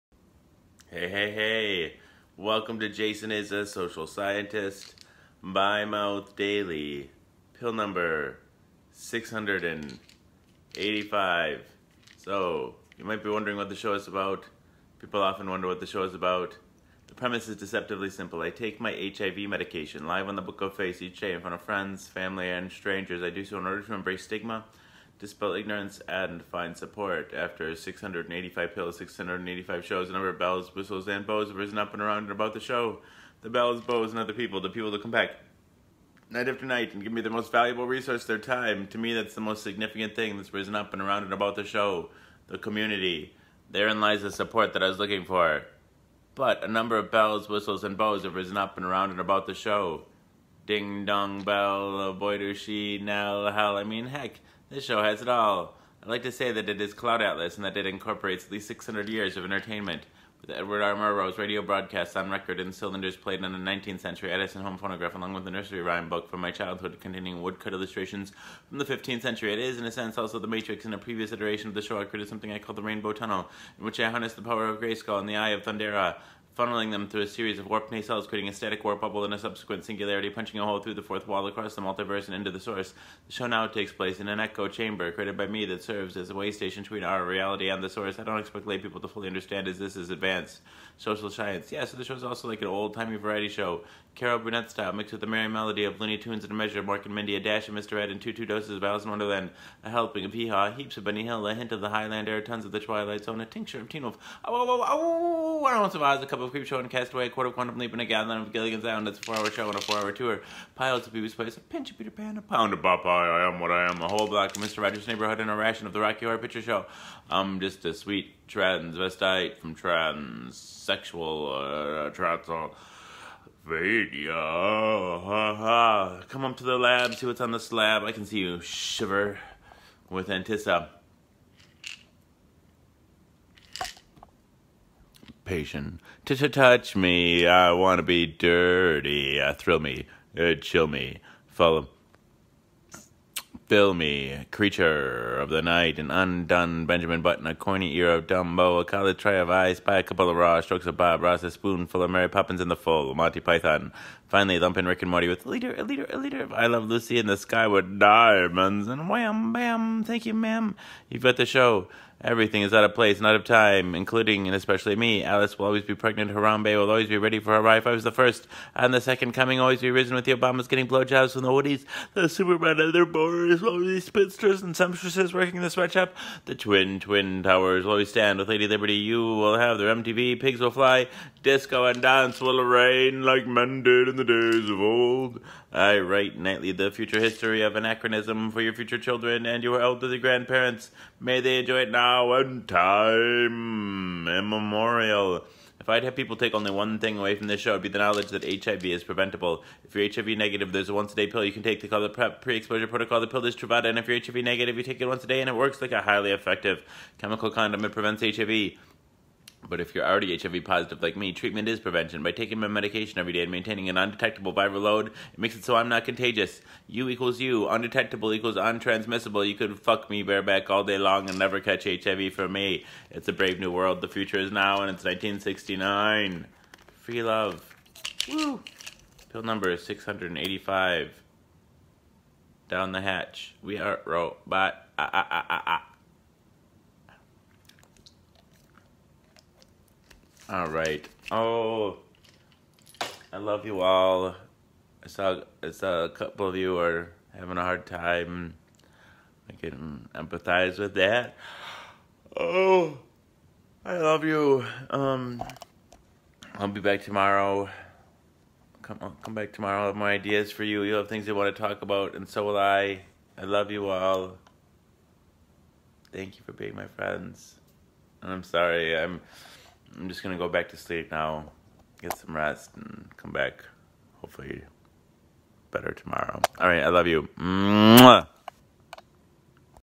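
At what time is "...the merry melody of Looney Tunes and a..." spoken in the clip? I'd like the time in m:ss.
1:35.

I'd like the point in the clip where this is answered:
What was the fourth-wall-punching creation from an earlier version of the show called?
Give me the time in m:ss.
1:12.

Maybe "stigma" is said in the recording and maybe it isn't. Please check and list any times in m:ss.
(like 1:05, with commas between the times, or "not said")
0:24.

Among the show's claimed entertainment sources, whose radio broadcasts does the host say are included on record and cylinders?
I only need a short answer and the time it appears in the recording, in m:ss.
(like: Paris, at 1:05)
Edward R. Murrow, at 1:00.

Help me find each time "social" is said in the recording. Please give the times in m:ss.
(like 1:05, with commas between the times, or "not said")
0:03, 1:30.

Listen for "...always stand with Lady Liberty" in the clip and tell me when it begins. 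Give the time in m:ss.
2:57.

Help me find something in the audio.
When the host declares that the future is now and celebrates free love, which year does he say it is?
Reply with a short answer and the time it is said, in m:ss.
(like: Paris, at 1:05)
1969, at 3:45.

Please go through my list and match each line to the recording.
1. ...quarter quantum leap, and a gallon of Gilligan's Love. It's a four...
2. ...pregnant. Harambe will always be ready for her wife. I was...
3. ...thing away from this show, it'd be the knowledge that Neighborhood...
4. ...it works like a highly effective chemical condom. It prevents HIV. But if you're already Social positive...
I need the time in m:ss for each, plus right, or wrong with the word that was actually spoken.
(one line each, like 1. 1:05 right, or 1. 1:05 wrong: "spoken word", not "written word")
1. 1:47 wrong: "Island", not "Love"
2. 2:45 right
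3. 3:16 wrong: "HIV", not "Neighborhood"
4. 3:25 wrong: "HIV", not "Social".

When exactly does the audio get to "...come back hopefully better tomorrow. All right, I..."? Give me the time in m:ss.
4:33.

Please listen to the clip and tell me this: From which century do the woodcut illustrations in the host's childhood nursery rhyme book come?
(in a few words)
15th century.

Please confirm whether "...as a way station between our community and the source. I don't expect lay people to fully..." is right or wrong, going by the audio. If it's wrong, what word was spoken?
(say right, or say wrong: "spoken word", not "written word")
wrong: "reality", not "community".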